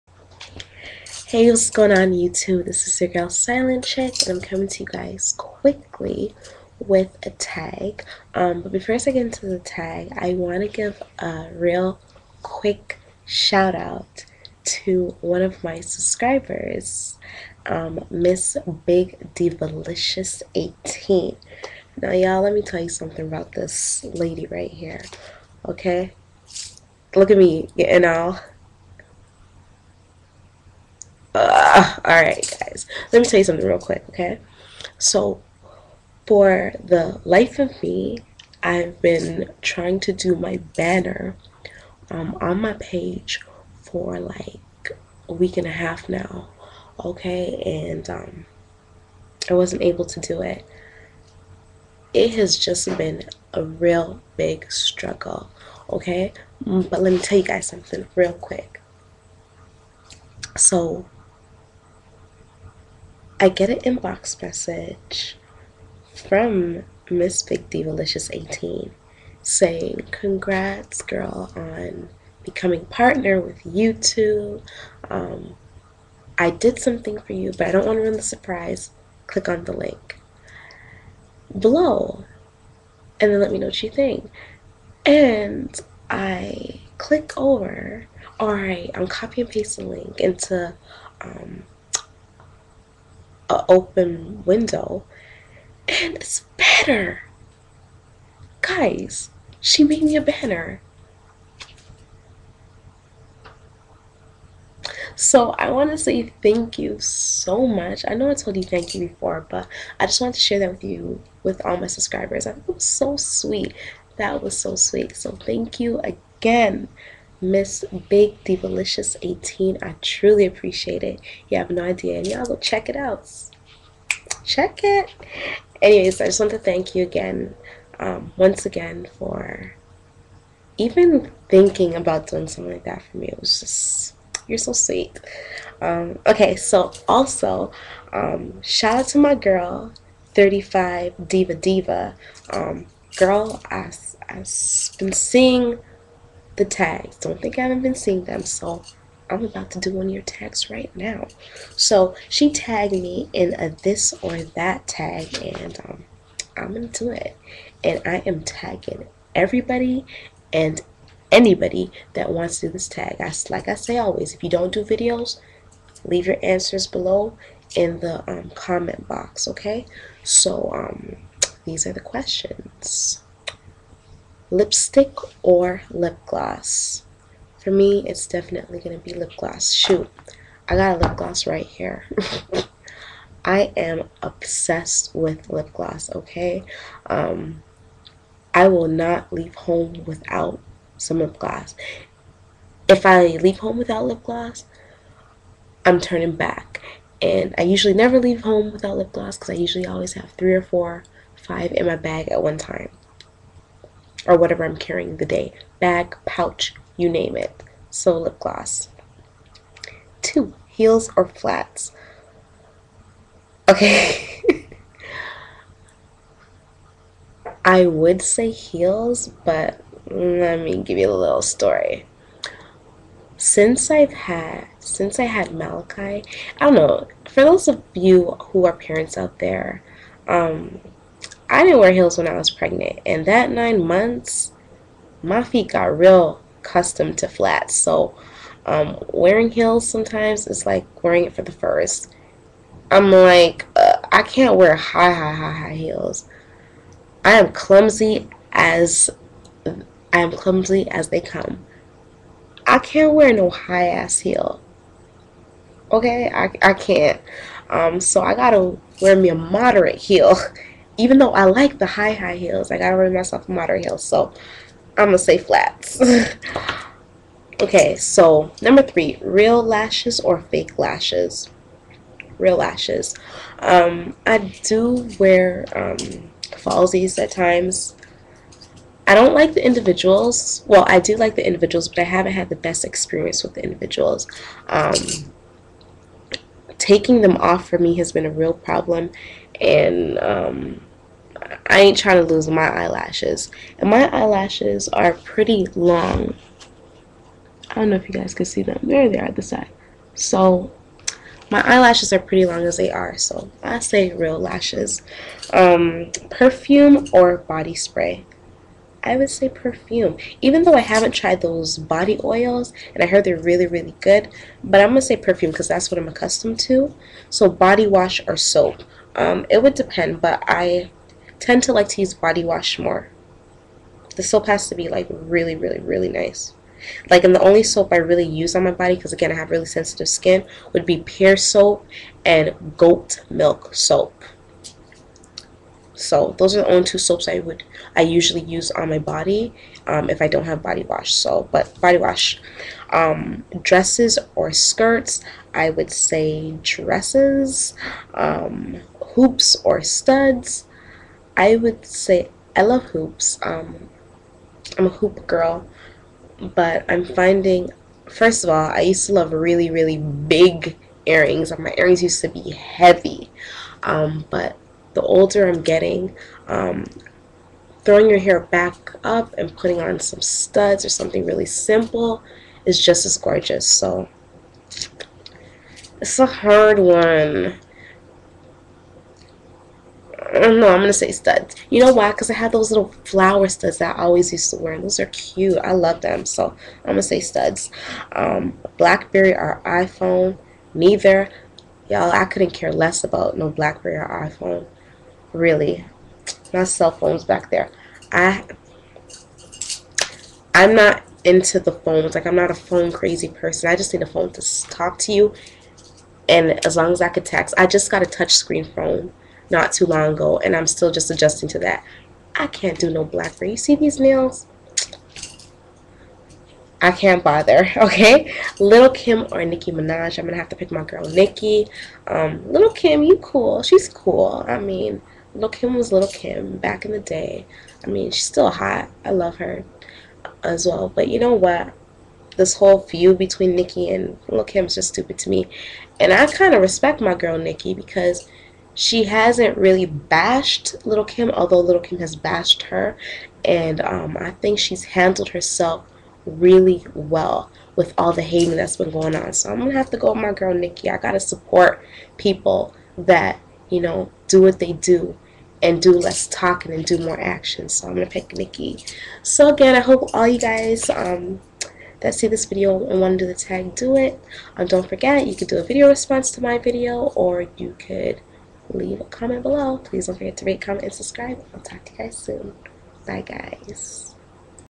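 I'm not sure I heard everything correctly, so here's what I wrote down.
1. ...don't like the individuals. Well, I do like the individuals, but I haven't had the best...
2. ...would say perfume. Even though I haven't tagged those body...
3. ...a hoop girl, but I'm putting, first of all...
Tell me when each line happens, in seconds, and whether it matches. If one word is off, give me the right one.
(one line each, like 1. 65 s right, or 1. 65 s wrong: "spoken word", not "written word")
1. 279 s right
2. 309 s wrong: "tried", not "tagged"
3. 354 s wrong: "finding", not "putting".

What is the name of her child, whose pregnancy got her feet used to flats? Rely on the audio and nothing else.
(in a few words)
Malachi.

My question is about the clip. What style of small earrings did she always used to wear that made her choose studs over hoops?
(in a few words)
Flower studs.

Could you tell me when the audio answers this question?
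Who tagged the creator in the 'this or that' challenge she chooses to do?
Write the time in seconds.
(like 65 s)
140 s.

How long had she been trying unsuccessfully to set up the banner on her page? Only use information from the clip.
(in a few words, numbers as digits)
A week and a half.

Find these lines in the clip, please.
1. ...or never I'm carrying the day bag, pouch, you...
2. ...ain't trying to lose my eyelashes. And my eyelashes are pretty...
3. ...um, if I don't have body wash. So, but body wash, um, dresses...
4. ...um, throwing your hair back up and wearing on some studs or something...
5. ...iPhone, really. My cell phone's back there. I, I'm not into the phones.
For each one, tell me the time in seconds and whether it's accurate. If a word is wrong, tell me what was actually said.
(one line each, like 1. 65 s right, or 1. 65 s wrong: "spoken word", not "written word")
1. 204 s wrong: "whatever", not "never"
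2. 291 s right
3. 339 s right
4. 366 s wrong: "putting", not "wearing"
5. 394 s right.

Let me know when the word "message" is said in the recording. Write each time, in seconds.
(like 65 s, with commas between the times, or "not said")
64 s.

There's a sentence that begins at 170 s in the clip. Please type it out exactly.
So um, these are the questions lipstick or lip gloss.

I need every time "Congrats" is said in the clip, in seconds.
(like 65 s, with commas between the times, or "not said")
70 s.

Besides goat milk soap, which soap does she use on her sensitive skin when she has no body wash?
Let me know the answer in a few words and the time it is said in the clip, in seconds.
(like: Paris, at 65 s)
Pear soap, at 331 s.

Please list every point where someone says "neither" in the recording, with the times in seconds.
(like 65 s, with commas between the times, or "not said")
390 s.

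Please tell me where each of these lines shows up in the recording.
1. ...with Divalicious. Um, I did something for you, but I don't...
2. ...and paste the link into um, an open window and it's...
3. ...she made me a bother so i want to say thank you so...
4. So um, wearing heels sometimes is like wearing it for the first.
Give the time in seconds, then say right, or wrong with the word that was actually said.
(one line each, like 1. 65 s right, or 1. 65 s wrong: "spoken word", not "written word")
1. 73 s wrong: "YouTube", not "Divalicious"
2. 89 s right
3. 99 s wrong: "banner", not "bother"
4. 237 s right.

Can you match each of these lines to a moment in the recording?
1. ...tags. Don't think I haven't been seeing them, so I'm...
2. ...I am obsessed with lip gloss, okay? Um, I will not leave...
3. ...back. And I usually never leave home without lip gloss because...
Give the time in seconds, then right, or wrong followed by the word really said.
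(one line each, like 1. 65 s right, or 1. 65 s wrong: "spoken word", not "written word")
1. 146 s right
2. 183 s right
3. 196 s right.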